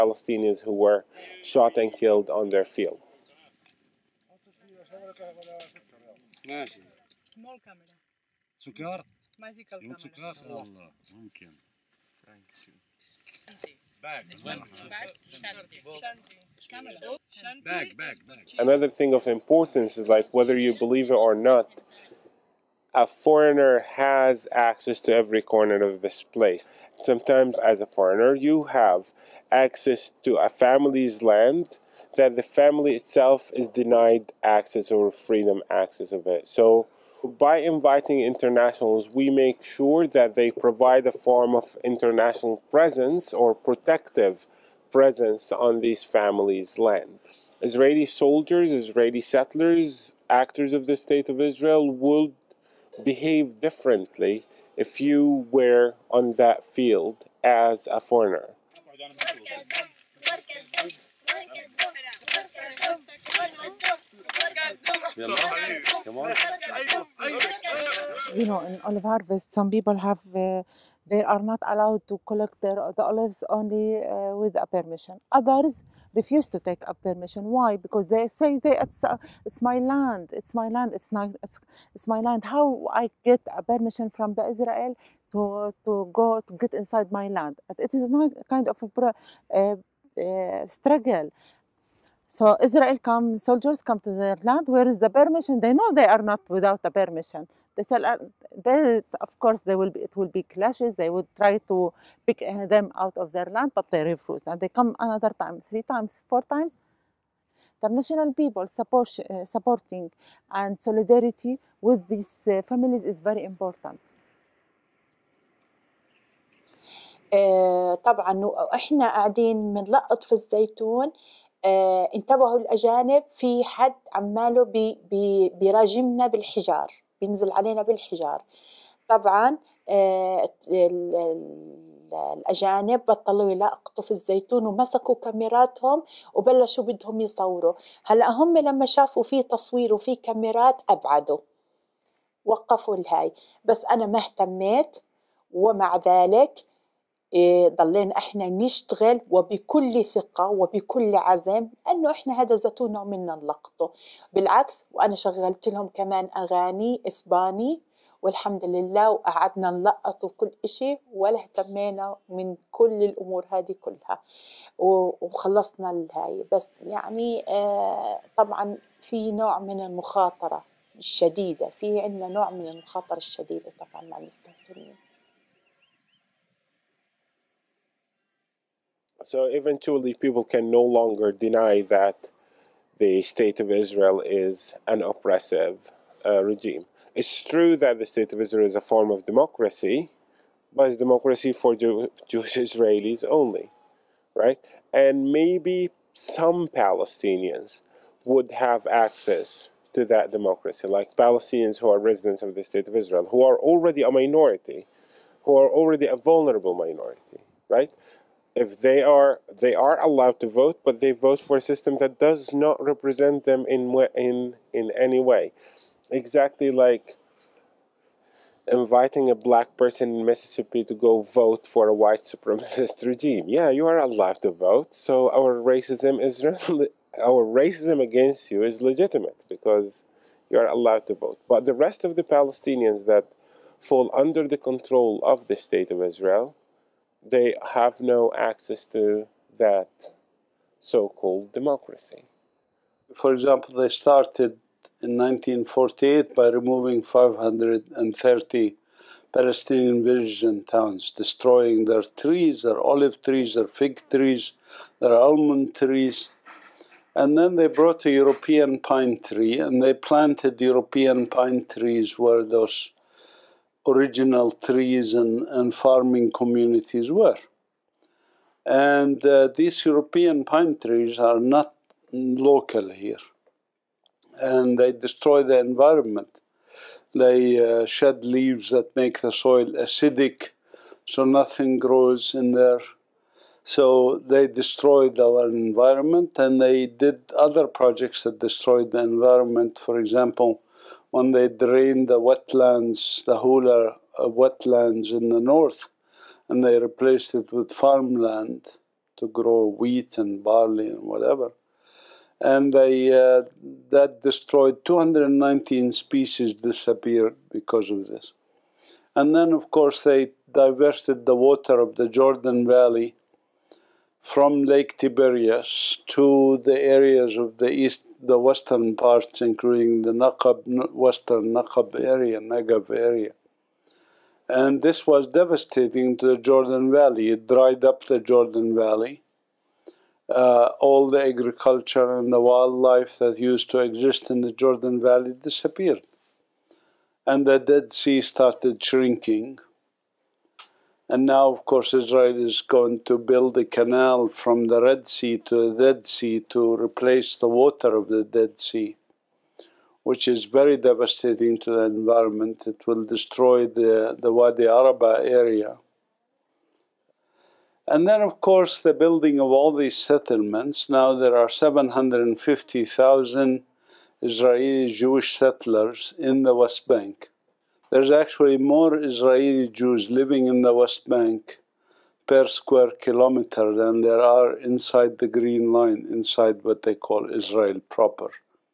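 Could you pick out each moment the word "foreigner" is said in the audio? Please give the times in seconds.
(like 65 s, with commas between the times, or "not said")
23 s, 27 s, 58 s.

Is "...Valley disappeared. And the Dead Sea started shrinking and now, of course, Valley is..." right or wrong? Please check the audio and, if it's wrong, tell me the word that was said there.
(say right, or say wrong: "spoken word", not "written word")
wrong: "Israel", not "Valley".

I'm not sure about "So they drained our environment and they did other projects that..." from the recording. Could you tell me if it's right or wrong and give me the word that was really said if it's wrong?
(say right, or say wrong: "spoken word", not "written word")
wrong: "destroyed", not "drained".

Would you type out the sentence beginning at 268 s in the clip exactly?
And uh, these European pine trees are not local here.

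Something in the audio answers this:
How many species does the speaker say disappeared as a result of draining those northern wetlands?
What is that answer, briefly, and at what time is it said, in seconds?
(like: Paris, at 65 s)
219, at 304 s.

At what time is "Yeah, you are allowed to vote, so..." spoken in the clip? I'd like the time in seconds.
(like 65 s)
223 s.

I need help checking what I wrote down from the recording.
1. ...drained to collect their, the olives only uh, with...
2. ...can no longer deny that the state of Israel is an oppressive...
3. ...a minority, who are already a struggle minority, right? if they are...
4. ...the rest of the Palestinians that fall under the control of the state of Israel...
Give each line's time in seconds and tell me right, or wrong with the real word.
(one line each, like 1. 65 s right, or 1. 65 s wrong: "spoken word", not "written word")
1. 71 s wrong: "allowed", not "drained"
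2. 180 s right
3. 204 s wrong: "vulnerable", not "struggle"
4. 231 s right.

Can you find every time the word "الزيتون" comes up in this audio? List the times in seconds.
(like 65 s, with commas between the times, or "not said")
120 s, 134 s.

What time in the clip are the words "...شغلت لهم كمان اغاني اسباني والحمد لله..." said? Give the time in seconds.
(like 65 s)
155 s.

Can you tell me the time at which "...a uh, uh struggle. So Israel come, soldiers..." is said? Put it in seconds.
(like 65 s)
88 s.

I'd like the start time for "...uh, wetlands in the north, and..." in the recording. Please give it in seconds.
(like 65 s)
294 s.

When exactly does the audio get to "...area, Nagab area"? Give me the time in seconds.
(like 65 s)
321 s.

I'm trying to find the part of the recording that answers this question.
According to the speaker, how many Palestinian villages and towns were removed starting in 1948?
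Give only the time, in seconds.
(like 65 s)
247 s.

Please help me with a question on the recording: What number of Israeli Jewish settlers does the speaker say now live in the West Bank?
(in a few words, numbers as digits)
750,000.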